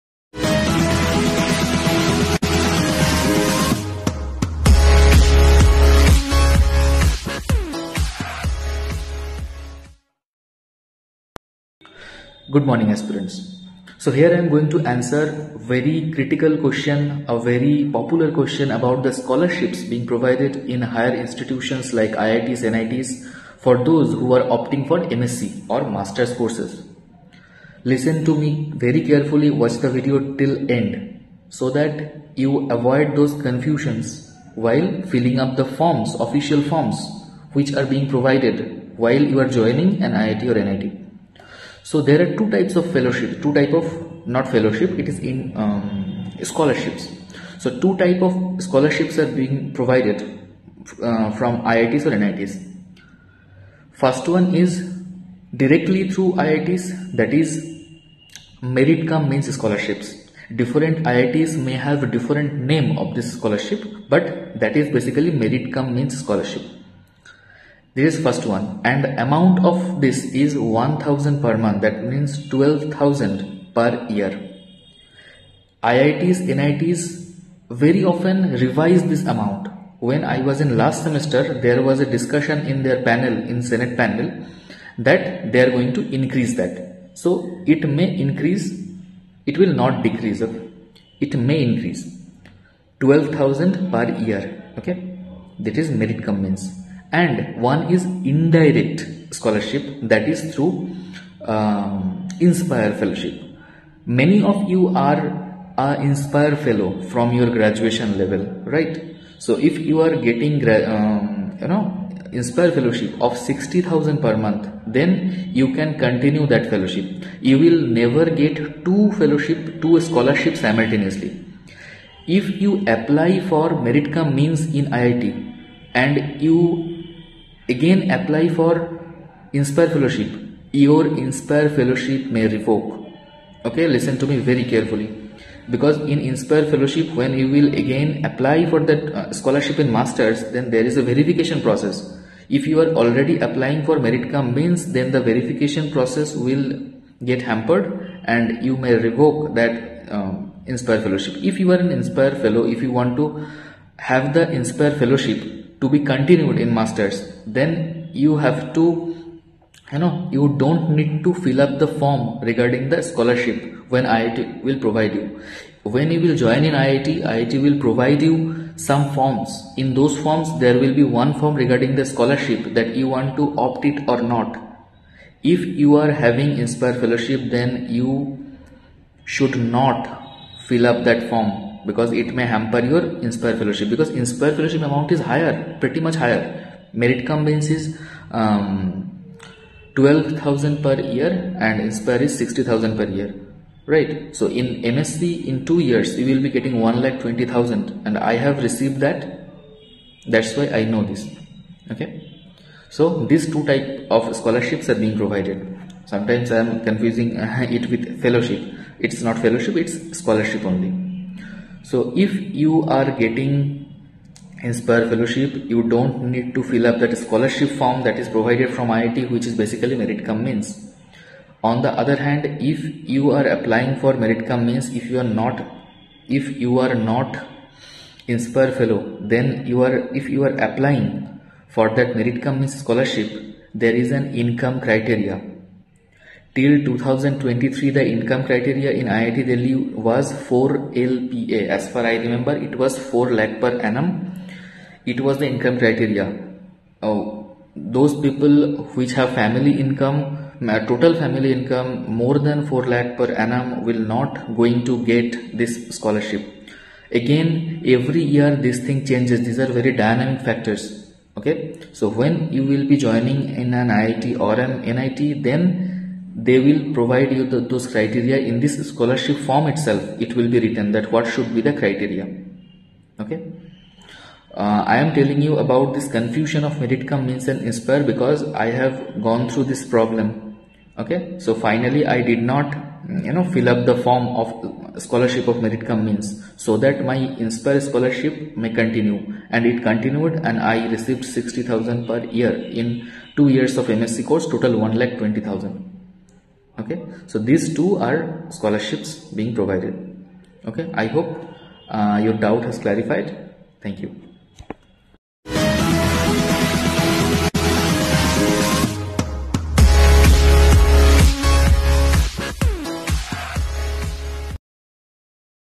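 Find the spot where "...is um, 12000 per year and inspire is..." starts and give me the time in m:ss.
3:07.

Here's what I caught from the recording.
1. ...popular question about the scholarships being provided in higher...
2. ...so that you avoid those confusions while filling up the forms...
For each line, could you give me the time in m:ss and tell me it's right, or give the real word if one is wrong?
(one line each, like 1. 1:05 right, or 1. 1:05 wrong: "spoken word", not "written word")
1. 0:17 right
2. 0:31 right.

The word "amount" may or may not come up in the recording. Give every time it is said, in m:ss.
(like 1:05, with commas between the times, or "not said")
1:09, 1:19, 3:04.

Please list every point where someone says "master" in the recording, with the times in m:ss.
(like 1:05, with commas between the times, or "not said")
0:25, 2:19, 2:36.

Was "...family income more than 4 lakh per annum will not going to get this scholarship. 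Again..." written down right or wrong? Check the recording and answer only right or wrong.
right.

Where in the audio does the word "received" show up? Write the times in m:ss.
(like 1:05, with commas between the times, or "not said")
3:18, 4:50.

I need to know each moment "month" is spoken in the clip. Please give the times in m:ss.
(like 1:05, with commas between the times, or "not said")
1:11, 1:54.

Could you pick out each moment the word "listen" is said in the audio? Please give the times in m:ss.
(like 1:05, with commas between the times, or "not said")
0:27, 2:13.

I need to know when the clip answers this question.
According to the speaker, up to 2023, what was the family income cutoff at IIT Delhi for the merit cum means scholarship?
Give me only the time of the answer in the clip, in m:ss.
4:00.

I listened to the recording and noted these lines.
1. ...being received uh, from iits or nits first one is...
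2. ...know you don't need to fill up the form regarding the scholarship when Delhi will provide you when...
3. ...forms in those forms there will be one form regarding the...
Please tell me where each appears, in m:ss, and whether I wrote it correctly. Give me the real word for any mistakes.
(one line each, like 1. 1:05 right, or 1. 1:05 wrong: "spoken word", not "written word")
1. 0:49 wrong: "provided", not "received"
2. 2:40 wrong: "IIT", not "Delhi"
3. 2:49 right.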